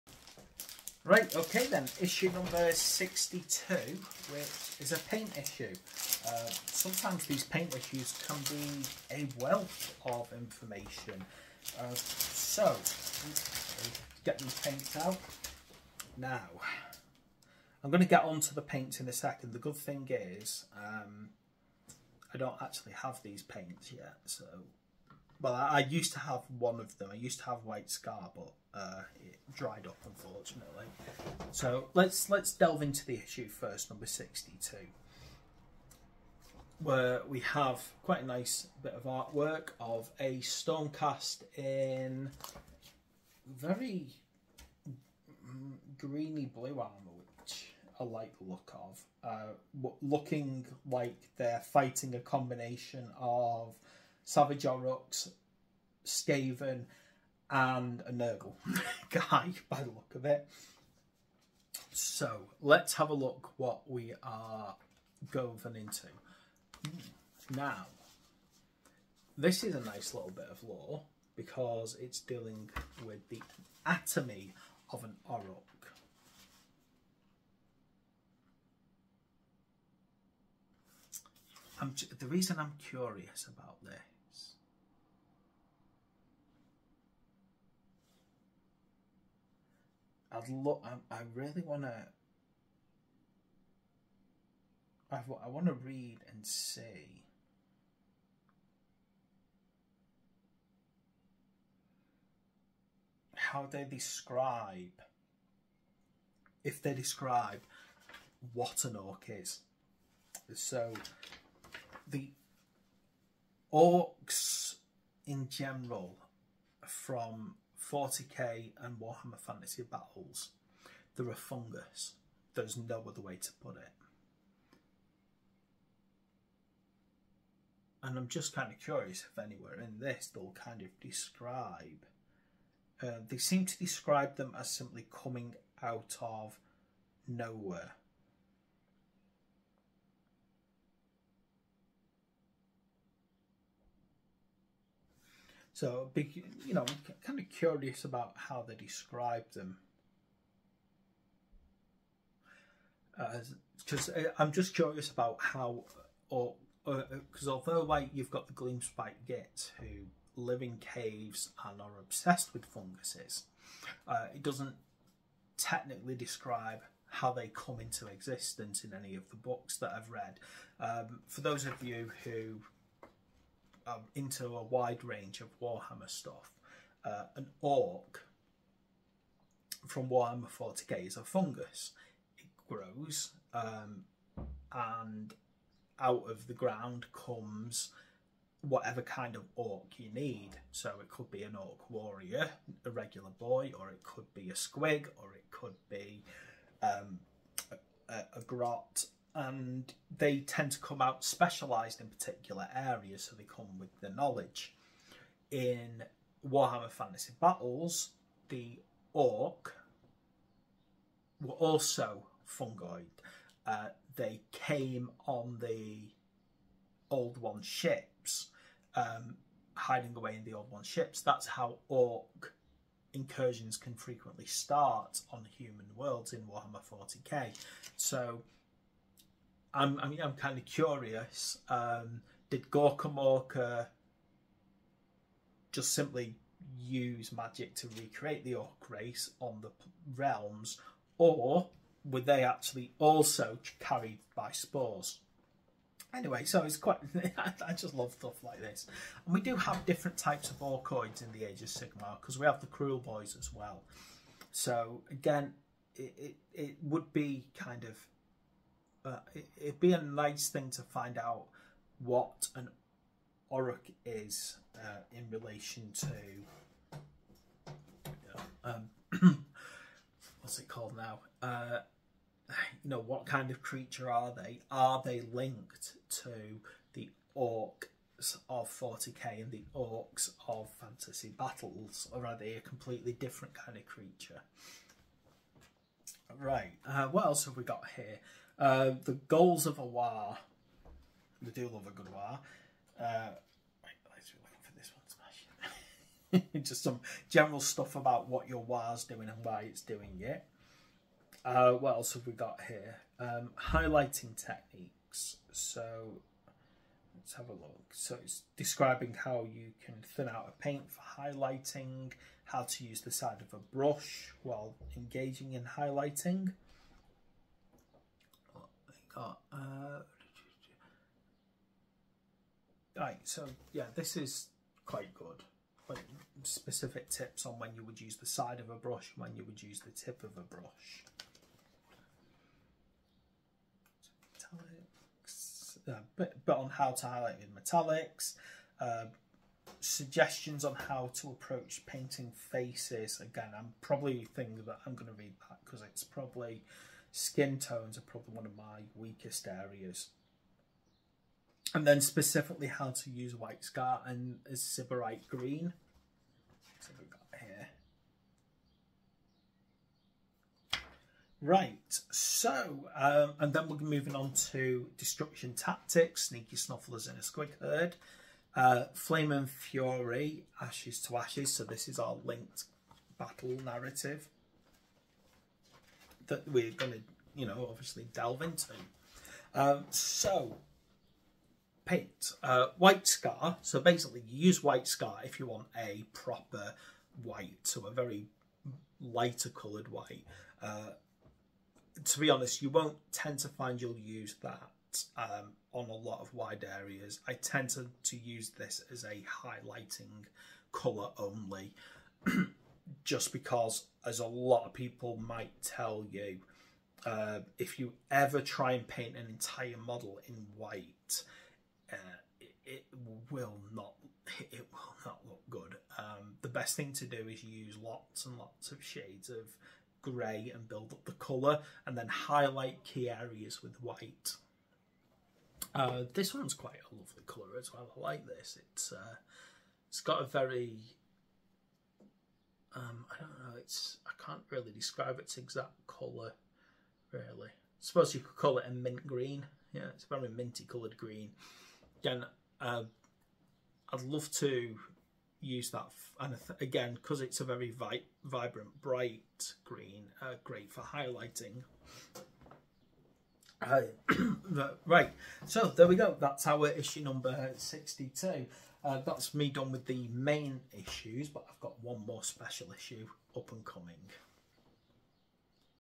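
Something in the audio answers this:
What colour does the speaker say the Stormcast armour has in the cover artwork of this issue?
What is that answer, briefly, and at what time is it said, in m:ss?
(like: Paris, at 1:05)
greeny blue, at 0:45.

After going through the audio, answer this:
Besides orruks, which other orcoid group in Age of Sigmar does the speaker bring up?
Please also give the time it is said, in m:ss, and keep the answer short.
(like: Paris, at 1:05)
Kruleboyz, at 4:12.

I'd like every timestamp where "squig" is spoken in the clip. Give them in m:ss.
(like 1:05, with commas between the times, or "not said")
3:14, 6:07.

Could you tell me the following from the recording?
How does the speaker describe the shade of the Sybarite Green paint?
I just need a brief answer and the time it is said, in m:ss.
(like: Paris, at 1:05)
mint green, at 7:18.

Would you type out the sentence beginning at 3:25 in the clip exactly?
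In Warhammer Fantasy Battles, the orc were also fungoid.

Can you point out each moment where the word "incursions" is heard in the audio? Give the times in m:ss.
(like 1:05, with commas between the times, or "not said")
3:43.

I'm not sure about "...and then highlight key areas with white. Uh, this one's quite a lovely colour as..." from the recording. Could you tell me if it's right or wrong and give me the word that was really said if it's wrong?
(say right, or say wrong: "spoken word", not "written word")
right.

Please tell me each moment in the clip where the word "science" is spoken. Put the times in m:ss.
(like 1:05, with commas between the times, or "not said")
not said.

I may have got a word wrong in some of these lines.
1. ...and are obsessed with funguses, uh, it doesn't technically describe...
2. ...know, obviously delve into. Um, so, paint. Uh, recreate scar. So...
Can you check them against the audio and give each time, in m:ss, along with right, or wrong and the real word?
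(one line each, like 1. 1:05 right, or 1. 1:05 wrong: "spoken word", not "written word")
1. 2:41 right
2. 6:17 wrong: "white", not "recreate".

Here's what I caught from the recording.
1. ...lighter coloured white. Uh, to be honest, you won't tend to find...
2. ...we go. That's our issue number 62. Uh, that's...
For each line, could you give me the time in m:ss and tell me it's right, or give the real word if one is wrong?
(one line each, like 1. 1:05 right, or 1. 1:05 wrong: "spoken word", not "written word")
1. 6:29 right
2. 7:35 right.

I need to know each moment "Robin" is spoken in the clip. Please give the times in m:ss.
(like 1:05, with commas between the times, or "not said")
not said.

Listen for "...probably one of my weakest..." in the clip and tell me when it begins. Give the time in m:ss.
5:48.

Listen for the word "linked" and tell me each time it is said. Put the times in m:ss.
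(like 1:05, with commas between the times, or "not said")
4:35, 6:12.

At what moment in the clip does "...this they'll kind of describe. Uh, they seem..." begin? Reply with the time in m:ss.
2:09.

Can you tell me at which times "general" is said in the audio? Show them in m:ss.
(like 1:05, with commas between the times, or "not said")
1:55, 4:57.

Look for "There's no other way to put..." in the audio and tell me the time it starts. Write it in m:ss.
2:02.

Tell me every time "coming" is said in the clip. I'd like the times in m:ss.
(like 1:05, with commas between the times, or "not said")
2:15, 7:43.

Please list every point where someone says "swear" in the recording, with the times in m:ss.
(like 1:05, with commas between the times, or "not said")
not said.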